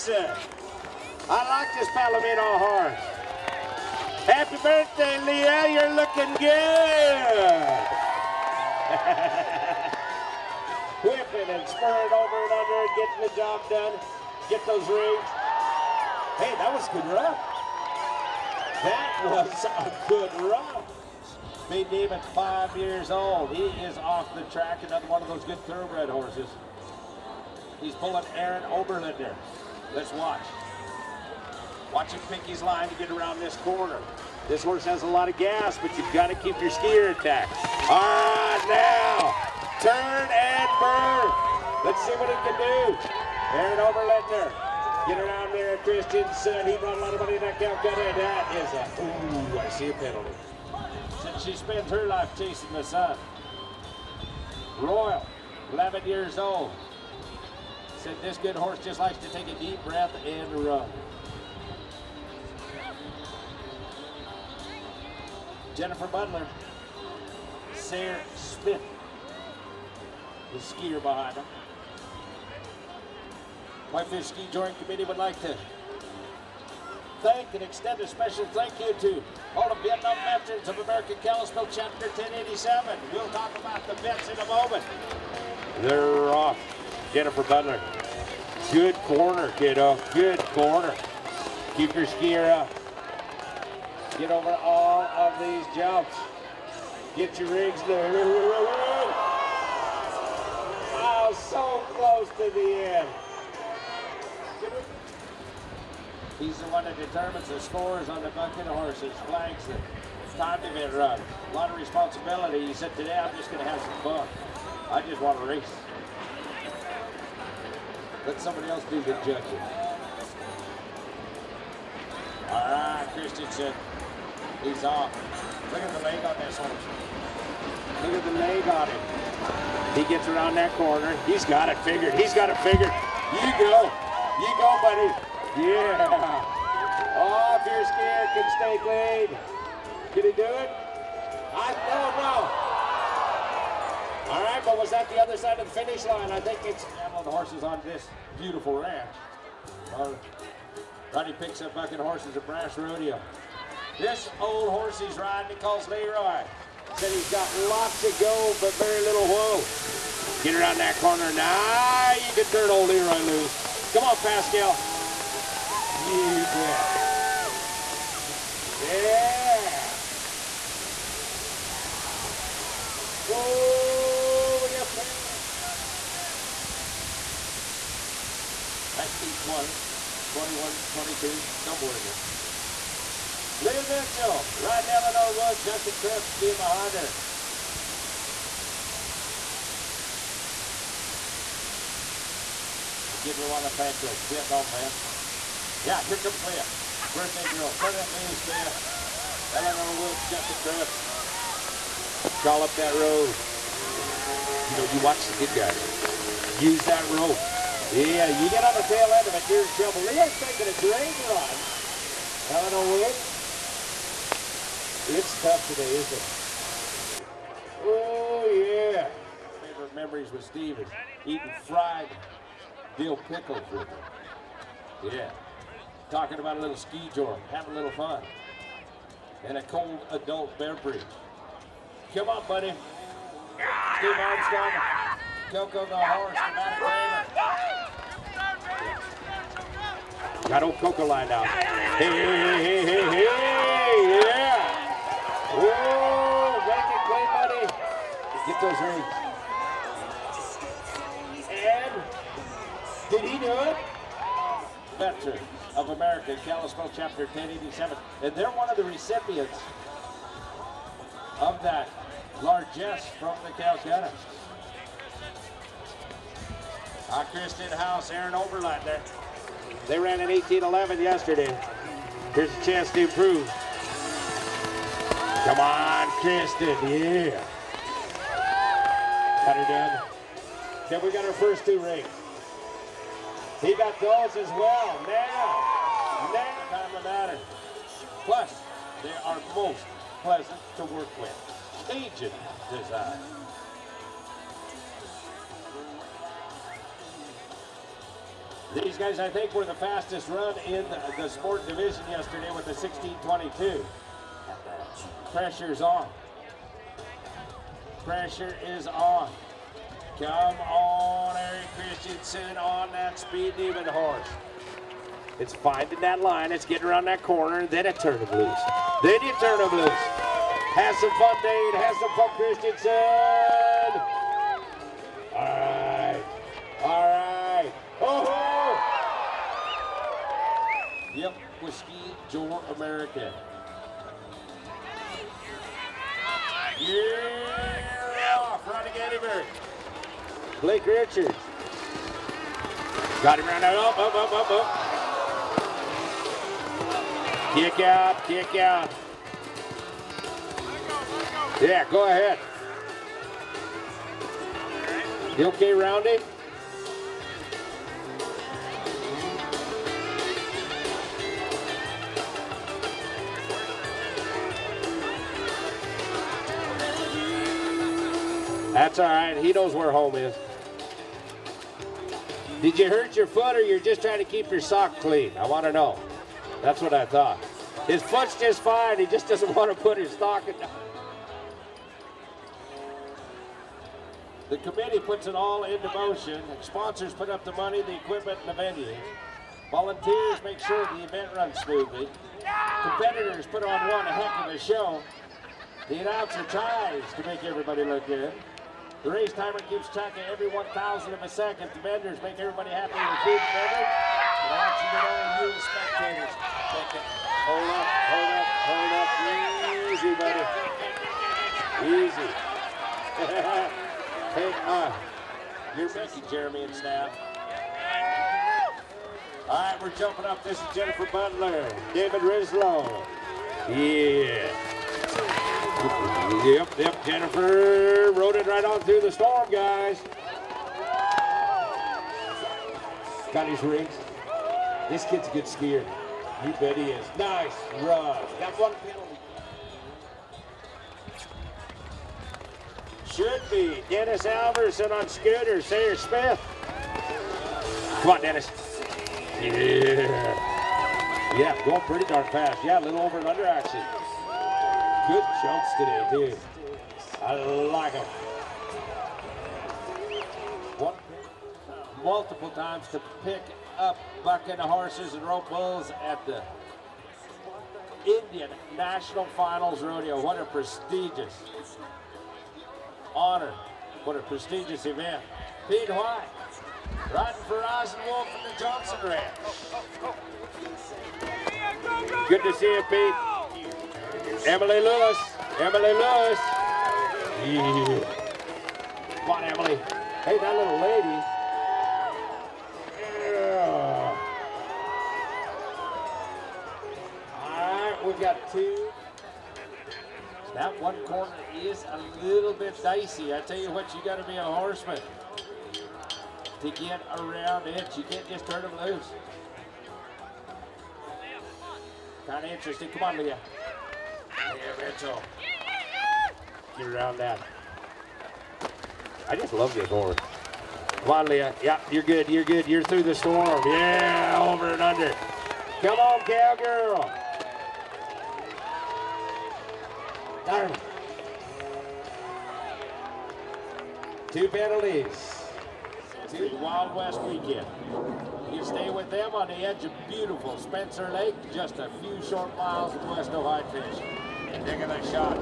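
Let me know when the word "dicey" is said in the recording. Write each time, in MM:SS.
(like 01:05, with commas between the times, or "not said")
08:22.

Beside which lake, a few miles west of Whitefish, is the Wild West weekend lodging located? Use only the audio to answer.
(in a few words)
Spencer Lake.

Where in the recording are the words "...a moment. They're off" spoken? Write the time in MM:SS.
01:24.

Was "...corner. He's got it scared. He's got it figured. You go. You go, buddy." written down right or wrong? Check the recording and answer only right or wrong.
wrong.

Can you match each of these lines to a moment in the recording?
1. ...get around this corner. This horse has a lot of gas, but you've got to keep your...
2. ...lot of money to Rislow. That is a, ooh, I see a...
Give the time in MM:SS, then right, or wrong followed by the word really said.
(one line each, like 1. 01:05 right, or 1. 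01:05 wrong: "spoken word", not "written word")
1. 00:32 right
2. 00:47 wrong: "Calcutta", not "Rislow".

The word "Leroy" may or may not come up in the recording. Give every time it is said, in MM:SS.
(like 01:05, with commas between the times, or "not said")
02:35, 02:42.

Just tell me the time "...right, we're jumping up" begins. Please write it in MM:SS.
06:59.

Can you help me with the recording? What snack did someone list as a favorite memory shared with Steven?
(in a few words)
fried dill pickles.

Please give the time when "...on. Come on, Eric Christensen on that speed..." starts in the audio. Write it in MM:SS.
05:08.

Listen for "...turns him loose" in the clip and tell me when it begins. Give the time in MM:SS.
05:18.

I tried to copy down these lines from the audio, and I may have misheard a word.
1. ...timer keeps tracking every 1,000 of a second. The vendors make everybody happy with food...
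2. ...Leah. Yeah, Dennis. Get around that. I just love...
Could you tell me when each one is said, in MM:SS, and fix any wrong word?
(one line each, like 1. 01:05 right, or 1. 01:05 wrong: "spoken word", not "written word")
1. 06:39 right
2. 08:33 wrong: "Mitchell", not "Dennis".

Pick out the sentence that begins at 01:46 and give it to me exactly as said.
He's the one that determines the scores on the bucket of horses, flags it.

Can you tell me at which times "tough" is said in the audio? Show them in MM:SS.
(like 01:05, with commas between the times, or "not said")
03:35.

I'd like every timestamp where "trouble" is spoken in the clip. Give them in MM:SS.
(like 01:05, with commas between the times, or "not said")
03:29.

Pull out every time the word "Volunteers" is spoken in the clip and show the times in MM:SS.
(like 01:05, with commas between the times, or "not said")
06:29.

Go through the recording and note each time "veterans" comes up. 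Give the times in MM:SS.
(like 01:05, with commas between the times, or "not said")
01:20, 04:14.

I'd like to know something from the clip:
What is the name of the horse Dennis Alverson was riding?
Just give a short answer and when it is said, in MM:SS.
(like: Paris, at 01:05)
Scooter, at 07:25.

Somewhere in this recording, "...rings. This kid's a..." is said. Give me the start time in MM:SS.
07:13.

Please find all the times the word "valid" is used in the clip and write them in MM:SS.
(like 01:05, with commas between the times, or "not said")
not said.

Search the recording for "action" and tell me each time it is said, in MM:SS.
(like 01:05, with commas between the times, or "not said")
06:44, 07:33.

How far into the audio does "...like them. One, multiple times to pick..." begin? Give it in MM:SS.
07:37.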